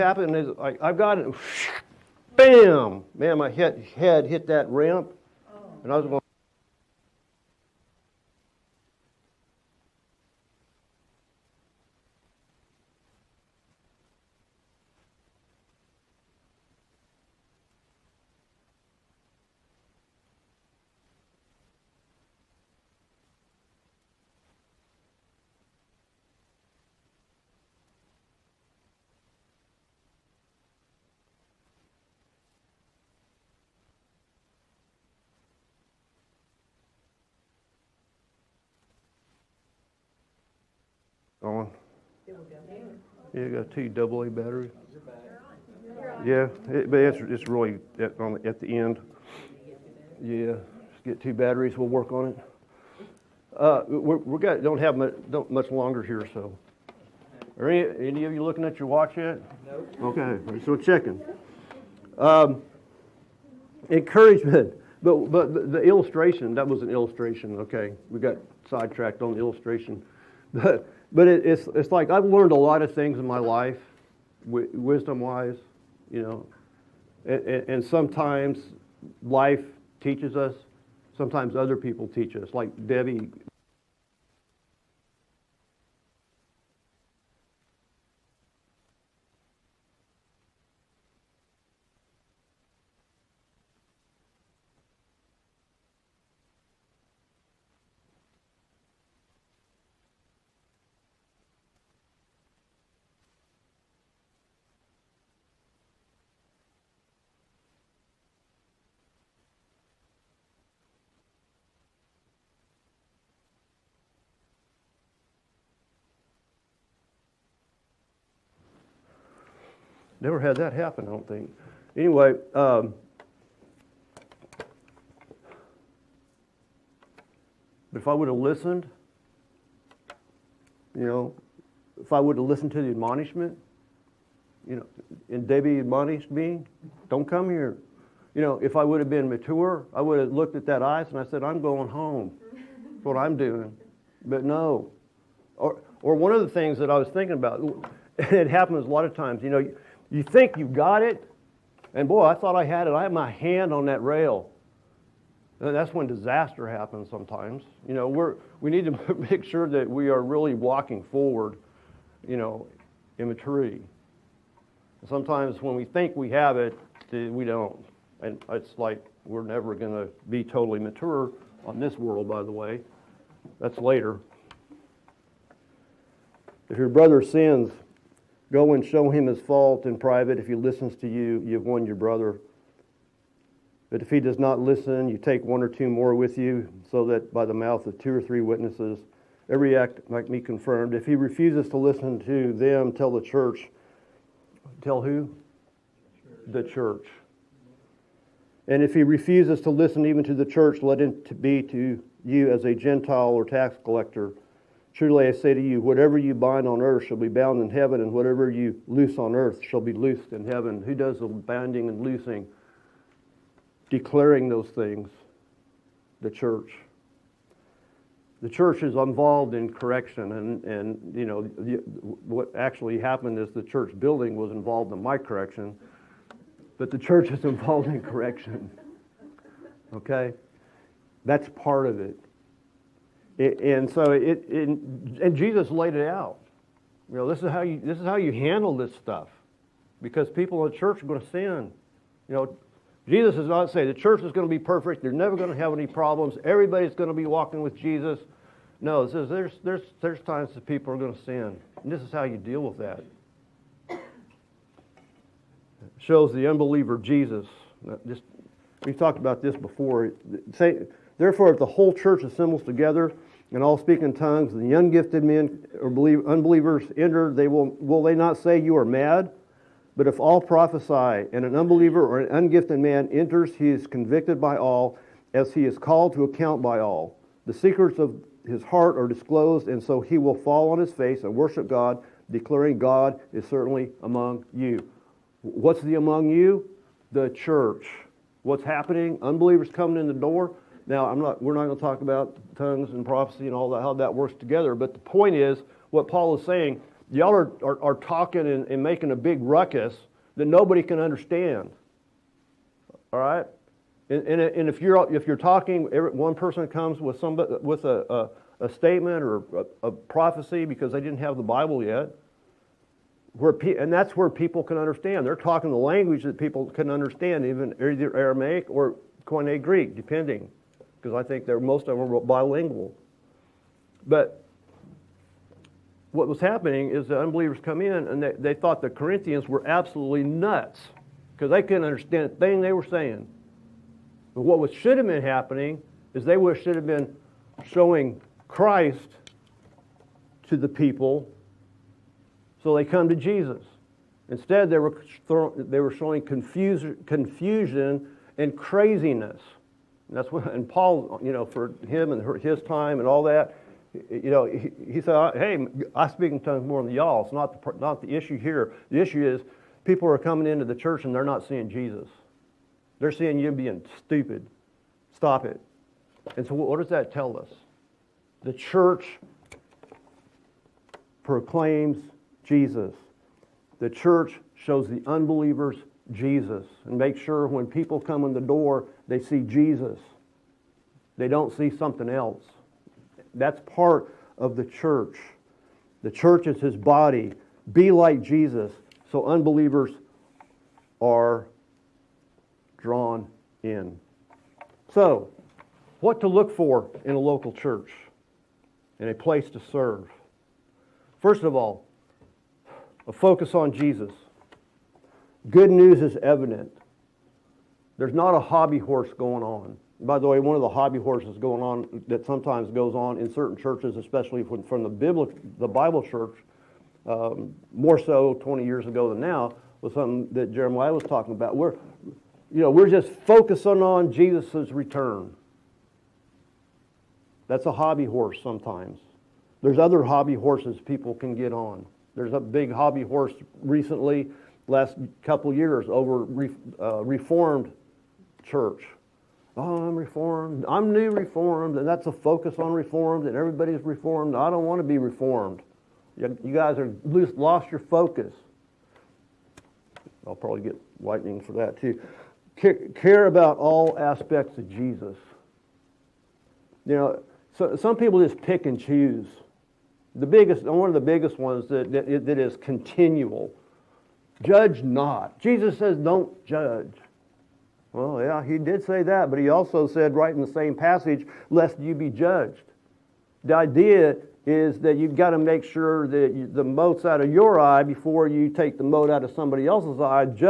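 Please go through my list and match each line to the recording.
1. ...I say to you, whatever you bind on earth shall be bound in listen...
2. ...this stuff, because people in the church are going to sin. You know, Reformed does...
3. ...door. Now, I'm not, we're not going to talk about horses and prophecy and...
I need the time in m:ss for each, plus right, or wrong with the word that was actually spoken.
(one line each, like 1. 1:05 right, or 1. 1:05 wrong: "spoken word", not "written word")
1. 3:25 wrong: "heaven", not "listen"
2. 3:58 wrong: "Jesus", not "Reformed"
3. 4:50 wrong: "tongues", not "horses".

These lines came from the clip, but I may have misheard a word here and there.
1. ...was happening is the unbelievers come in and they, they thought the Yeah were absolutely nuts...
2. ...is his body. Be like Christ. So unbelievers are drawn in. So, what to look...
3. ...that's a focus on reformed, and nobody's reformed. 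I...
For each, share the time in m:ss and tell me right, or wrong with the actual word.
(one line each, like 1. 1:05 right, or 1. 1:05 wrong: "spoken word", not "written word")
1. 5:26 wrong: "Corinthians", not "Yeah"
2. 6:26 wrong: "Jesus", not "Christ"
3. 7:21 wrong: "everybody", not "nobody".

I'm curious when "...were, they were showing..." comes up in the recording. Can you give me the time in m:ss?
5:44.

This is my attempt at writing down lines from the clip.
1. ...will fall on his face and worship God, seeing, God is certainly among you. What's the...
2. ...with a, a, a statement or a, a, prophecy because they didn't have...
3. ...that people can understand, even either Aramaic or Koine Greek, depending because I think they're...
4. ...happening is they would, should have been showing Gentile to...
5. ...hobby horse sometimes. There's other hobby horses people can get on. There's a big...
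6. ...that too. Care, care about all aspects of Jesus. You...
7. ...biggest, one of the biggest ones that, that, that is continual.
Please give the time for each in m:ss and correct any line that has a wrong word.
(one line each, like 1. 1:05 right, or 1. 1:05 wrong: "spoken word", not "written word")
1. 4:40 wrong: "declaring", not "seeing"
2. 5:07 right
3. 5:16 right
4. 5:35 wrong: "Christ", not "Gentile"
5. 7:07 right
6. 7:31 right
7. 7:40 right.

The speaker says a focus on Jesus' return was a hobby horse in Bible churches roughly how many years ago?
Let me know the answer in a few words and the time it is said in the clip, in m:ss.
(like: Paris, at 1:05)
20 years, at 6:58.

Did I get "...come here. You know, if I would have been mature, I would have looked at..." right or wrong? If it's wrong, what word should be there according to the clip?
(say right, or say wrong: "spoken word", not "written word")
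right.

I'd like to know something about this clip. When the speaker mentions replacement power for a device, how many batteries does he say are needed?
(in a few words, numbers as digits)
2.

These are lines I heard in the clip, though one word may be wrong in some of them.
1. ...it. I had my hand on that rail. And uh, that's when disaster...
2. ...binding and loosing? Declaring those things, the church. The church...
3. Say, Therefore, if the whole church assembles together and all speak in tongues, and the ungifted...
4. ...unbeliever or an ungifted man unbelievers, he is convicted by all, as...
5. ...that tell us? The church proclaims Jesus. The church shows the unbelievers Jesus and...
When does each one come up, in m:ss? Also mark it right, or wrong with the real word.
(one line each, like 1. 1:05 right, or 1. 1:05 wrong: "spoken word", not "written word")
1. 2:32 right
2. 3:31 right
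3. 4:20 right
4. 4:31 wrong: "enters", not "unbelievers"
5. 6:06 right.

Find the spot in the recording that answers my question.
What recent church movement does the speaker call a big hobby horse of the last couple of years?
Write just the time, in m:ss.
7:17.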